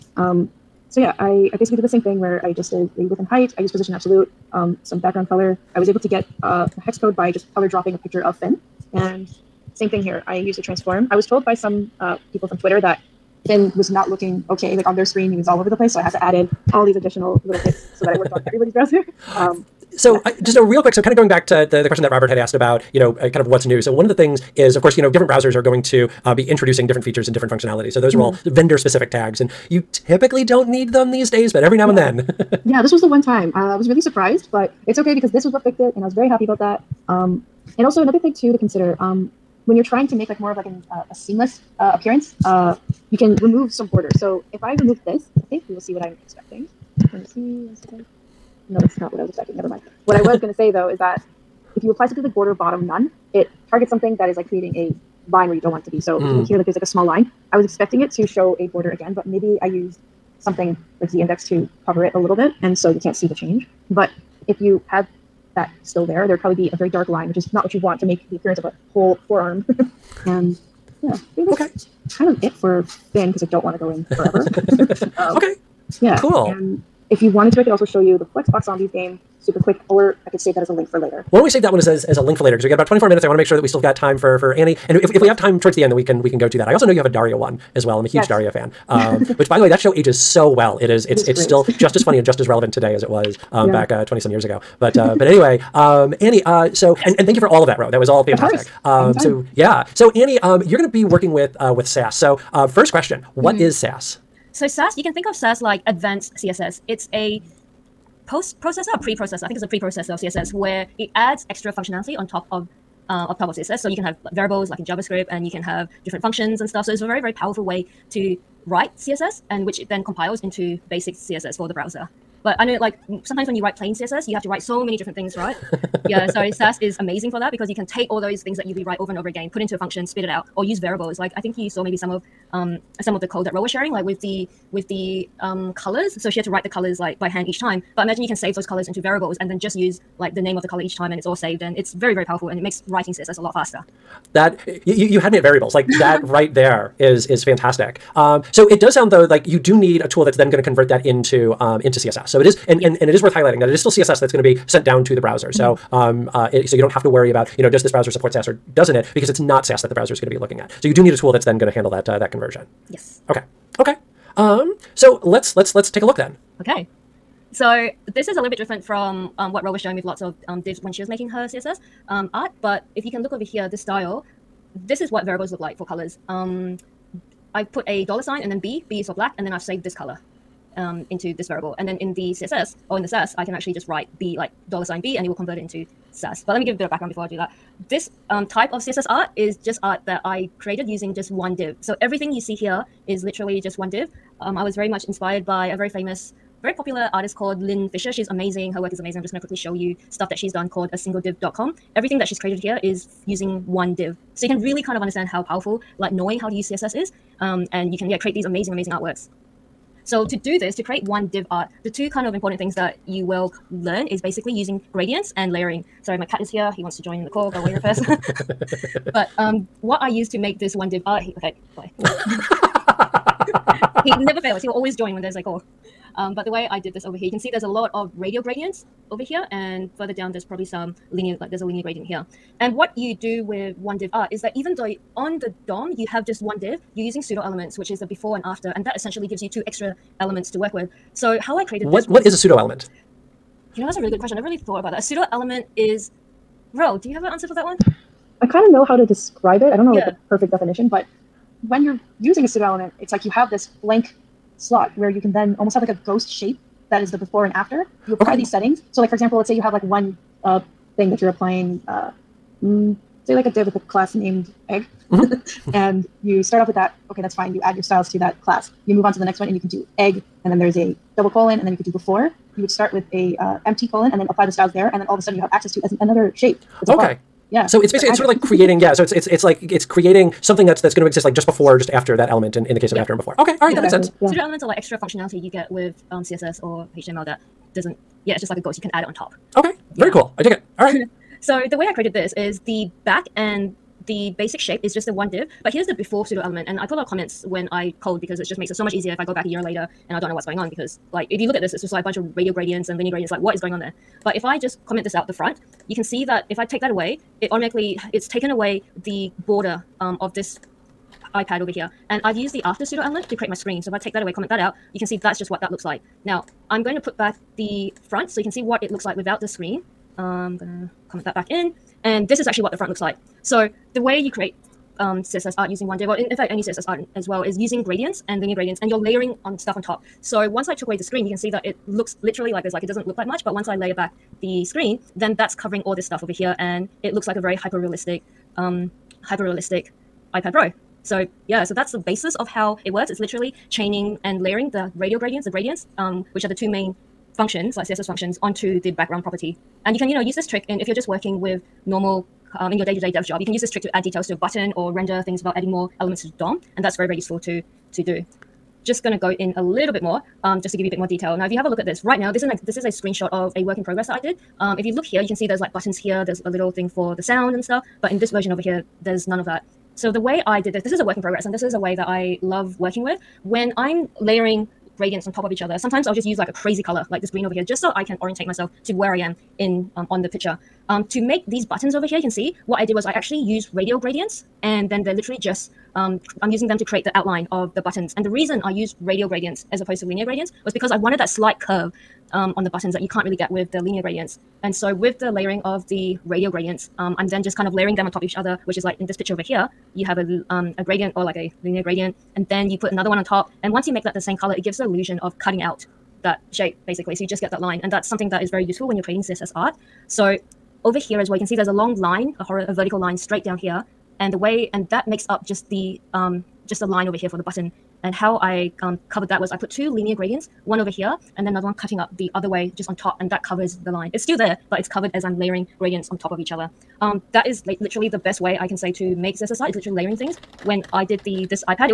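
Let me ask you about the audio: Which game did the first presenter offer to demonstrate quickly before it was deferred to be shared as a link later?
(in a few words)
Flexbox Zombies.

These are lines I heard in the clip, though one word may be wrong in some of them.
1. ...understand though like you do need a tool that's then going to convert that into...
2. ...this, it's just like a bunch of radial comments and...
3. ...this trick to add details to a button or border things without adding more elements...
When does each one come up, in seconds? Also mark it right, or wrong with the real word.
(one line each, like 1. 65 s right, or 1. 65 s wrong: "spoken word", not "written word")
1. 148 s wrong: "sound", not "understand"
2. 301 s wrong: "gradients", not "comments"
3. 353 s wrong: "render", not "border".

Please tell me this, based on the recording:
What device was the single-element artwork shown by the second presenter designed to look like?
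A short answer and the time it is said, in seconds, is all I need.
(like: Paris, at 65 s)
iPad Pro, at 340 s.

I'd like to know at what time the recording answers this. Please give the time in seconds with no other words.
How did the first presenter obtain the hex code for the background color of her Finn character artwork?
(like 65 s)
7 s.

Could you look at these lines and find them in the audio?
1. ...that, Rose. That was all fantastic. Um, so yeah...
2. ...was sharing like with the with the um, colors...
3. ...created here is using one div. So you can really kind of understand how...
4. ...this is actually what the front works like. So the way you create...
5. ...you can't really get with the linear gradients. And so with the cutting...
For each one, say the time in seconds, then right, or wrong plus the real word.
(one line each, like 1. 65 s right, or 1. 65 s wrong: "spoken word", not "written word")
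1. 97 s right
2. 133 s right
3. 202 s right
4. 322 s wrong: "looks", not "works"
5. 392 s wrong: "layering", not "cutting".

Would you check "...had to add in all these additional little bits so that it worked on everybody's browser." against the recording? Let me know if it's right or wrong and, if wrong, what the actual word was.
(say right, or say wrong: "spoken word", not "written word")
right.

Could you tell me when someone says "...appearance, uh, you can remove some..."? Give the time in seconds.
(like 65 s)
41 s.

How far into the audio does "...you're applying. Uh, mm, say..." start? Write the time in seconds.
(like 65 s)
261 s.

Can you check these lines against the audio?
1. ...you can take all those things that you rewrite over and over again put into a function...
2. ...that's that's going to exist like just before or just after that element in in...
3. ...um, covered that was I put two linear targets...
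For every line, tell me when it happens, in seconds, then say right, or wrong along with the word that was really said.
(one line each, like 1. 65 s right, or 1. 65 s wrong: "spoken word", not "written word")
1. 127 s right
2. 280 s right
3. 418 s wrong: "gradients", not "targets".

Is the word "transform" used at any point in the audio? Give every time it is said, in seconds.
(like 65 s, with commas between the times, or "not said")
10 s.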